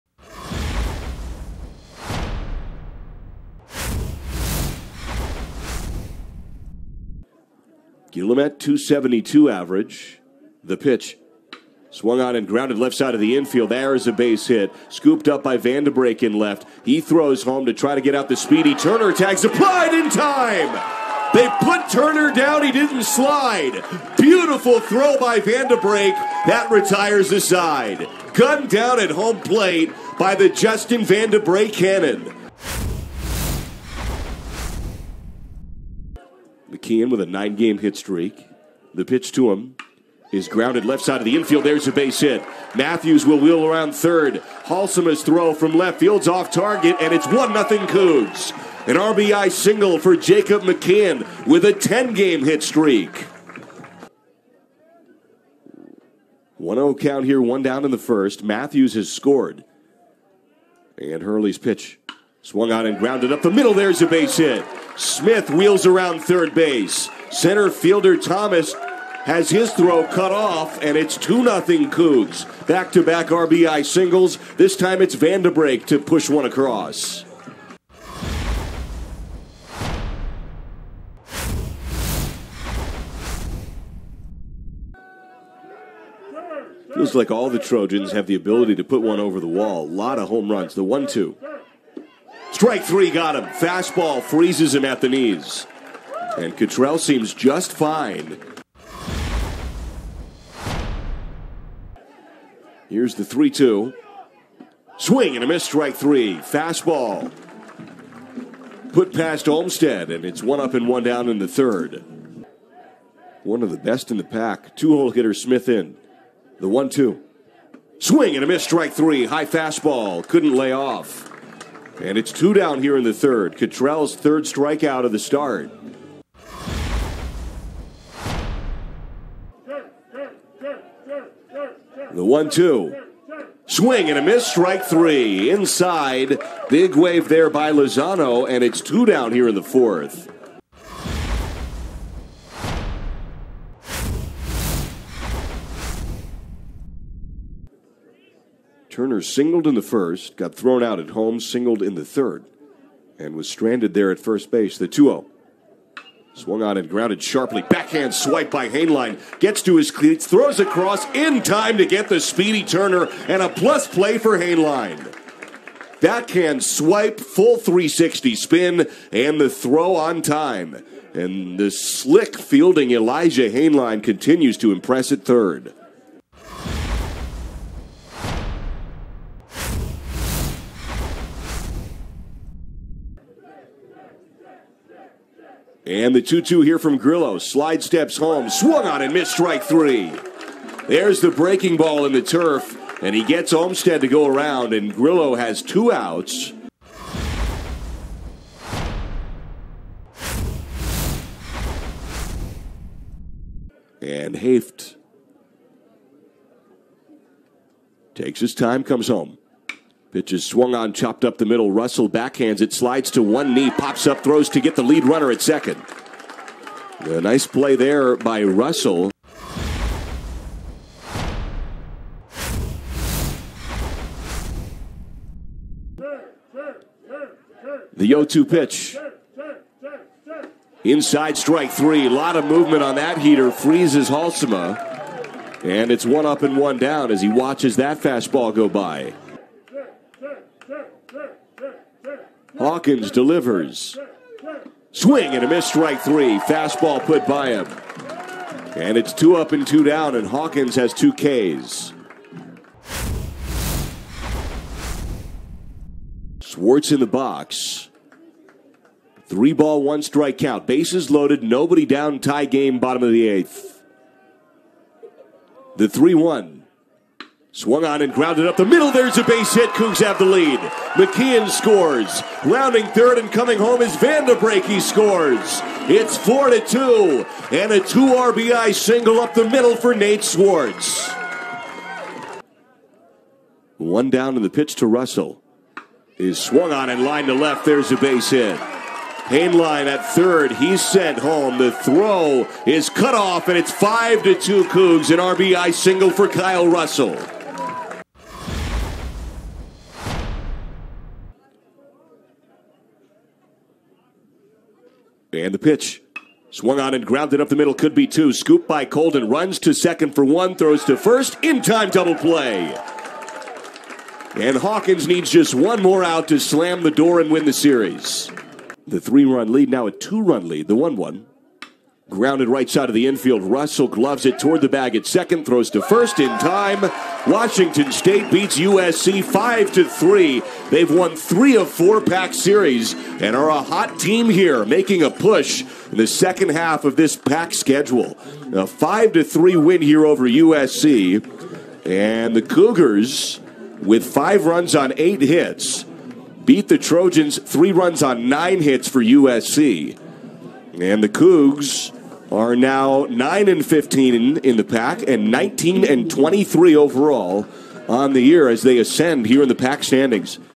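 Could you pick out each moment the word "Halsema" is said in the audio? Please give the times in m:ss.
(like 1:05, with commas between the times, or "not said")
0:44, 3:54.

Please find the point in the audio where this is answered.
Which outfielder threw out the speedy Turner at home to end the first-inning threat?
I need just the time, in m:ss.
0:30.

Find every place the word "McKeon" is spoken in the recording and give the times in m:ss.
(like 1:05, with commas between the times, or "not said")
0:36, 0:50, 4:30.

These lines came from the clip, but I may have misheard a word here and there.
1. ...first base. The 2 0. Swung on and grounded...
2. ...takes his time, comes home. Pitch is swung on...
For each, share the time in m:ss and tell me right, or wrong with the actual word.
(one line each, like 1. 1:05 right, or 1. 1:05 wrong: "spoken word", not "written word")
1. 2:34 right
2. 3:28 right.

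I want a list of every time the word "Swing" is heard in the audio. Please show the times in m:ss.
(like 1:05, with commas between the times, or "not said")
1:44, 1:57, 2:13, 4:04.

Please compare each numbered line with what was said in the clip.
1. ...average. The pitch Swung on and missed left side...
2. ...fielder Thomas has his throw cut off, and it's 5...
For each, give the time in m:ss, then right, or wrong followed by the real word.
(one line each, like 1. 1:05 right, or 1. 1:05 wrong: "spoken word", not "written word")
1. 0:09 wrong: "grounded", not "missed"
2. 1:07 wrong: "2", not "5".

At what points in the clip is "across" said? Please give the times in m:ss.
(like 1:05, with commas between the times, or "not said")
1:16, 2:40.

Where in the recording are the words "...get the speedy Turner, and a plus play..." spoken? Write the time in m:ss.
2:41.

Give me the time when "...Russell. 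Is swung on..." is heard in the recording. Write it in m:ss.
4:44.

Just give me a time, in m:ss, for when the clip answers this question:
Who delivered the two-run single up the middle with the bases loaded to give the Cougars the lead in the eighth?
4:39.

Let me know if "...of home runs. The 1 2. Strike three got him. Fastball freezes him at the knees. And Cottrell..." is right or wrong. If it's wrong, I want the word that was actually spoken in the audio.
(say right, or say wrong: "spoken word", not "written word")
right.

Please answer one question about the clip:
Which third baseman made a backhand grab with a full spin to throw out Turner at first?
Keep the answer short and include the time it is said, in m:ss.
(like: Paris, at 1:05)
Elijah Hainline, at 2:52.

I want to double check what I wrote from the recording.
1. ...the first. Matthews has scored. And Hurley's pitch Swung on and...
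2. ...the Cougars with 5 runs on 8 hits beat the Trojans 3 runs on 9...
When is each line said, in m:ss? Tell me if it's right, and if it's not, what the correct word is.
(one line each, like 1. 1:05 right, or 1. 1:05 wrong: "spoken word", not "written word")
1. 0:57 right
2. 5:42 right.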